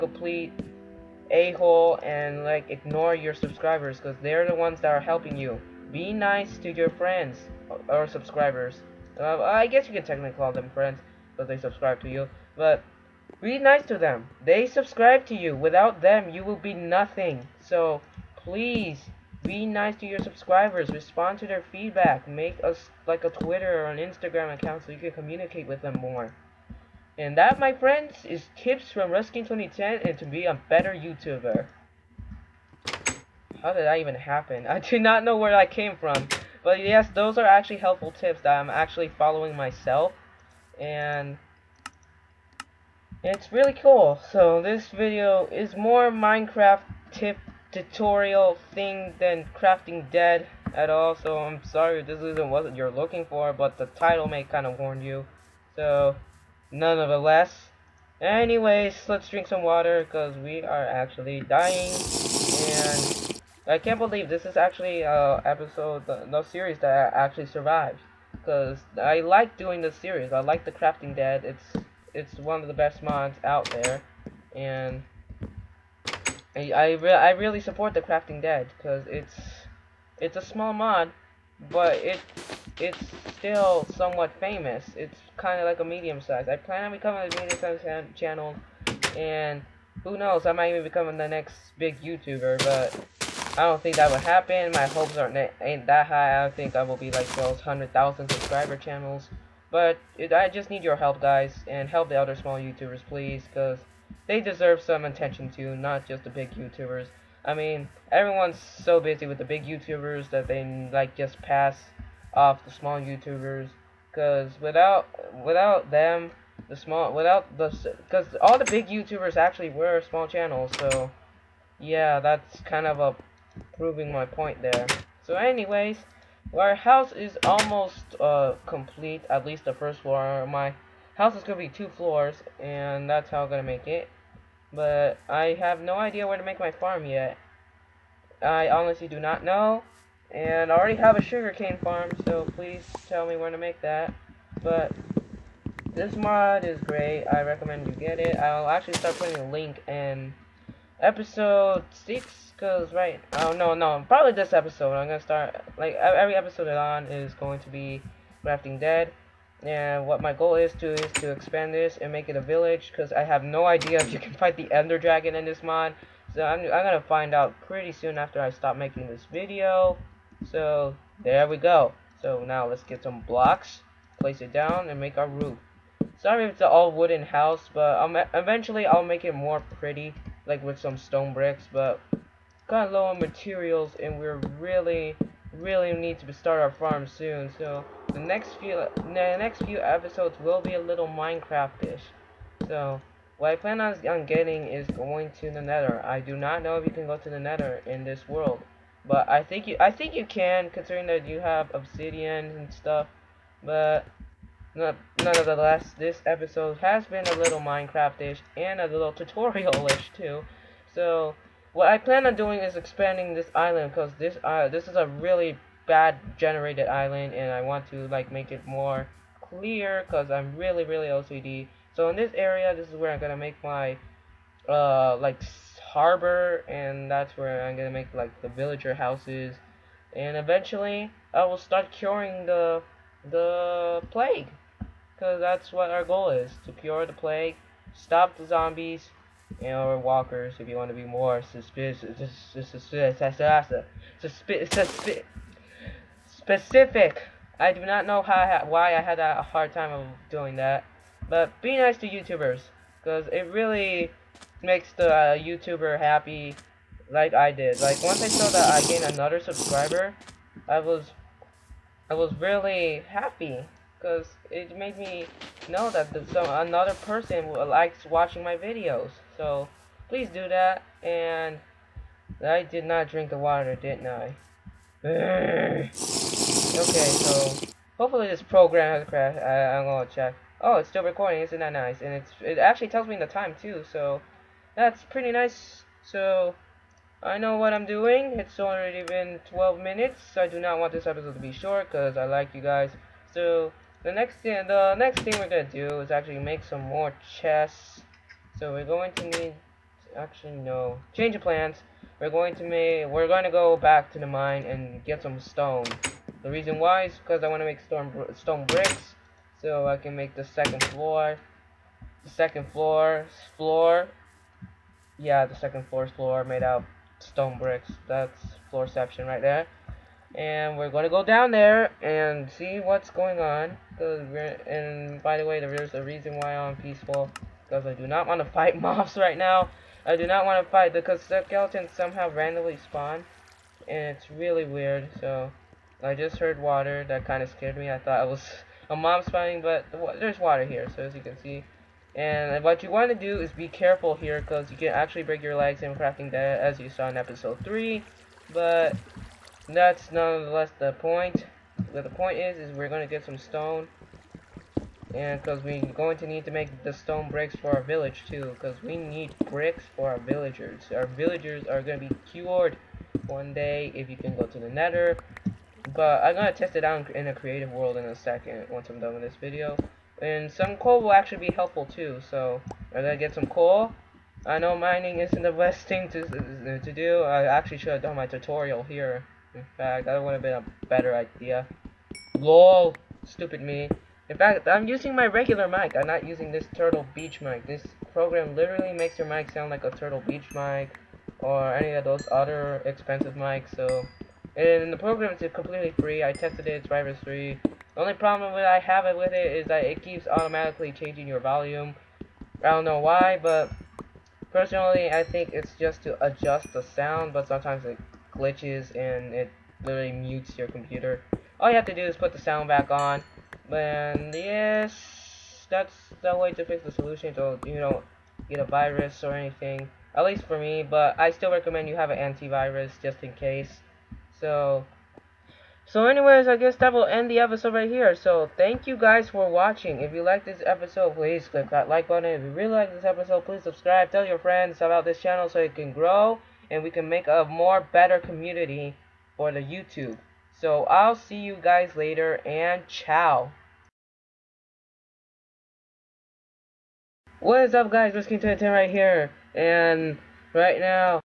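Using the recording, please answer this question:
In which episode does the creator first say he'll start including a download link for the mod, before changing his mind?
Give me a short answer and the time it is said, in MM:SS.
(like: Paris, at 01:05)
Episode 6, at 02:30.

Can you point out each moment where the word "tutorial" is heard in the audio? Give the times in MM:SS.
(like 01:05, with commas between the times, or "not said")
00:47, 03:29, 06:18.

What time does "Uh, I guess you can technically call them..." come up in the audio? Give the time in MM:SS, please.
00:09.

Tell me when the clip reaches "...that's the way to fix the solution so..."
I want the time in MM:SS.
06:55.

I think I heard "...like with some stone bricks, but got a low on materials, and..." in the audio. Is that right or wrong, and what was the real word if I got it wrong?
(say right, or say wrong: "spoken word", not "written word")
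right.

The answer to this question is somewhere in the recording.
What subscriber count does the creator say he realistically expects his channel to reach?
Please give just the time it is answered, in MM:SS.
01:37.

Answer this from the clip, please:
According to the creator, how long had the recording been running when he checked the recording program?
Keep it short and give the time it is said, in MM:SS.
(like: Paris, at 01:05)
12 minutes, at 04:49.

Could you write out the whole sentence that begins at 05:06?
The reason why is because I want to make stone, stone bricks so I can make the second floor.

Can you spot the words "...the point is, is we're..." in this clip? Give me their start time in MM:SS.
05:52.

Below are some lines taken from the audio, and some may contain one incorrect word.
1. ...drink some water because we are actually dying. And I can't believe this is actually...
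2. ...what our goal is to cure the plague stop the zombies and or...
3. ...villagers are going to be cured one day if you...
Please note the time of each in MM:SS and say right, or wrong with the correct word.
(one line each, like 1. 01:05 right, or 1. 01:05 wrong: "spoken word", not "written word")
1. 00:59 right
2. 03:55 right
3. 06:01 right.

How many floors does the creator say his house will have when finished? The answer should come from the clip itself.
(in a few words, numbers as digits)
2.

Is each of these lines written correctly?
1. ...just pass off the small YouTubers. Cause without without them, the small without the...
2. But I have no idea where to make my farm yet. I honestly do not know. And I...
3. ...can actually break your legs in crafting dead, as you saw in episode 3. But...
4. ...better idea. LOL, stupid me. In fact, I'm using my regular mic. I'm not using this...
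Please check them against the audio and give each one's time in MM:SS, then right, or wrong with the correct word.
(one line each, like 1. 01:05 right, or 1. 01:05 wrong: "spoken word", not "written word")
1. 01:51 right
2. 02:14 right
3. 05:44 right
4. 06:20 right.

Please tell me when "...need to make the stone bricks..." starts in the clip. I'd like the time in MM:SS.
05:56.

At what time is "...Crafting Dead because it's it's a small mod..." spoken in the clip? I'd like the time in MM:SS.
01:18.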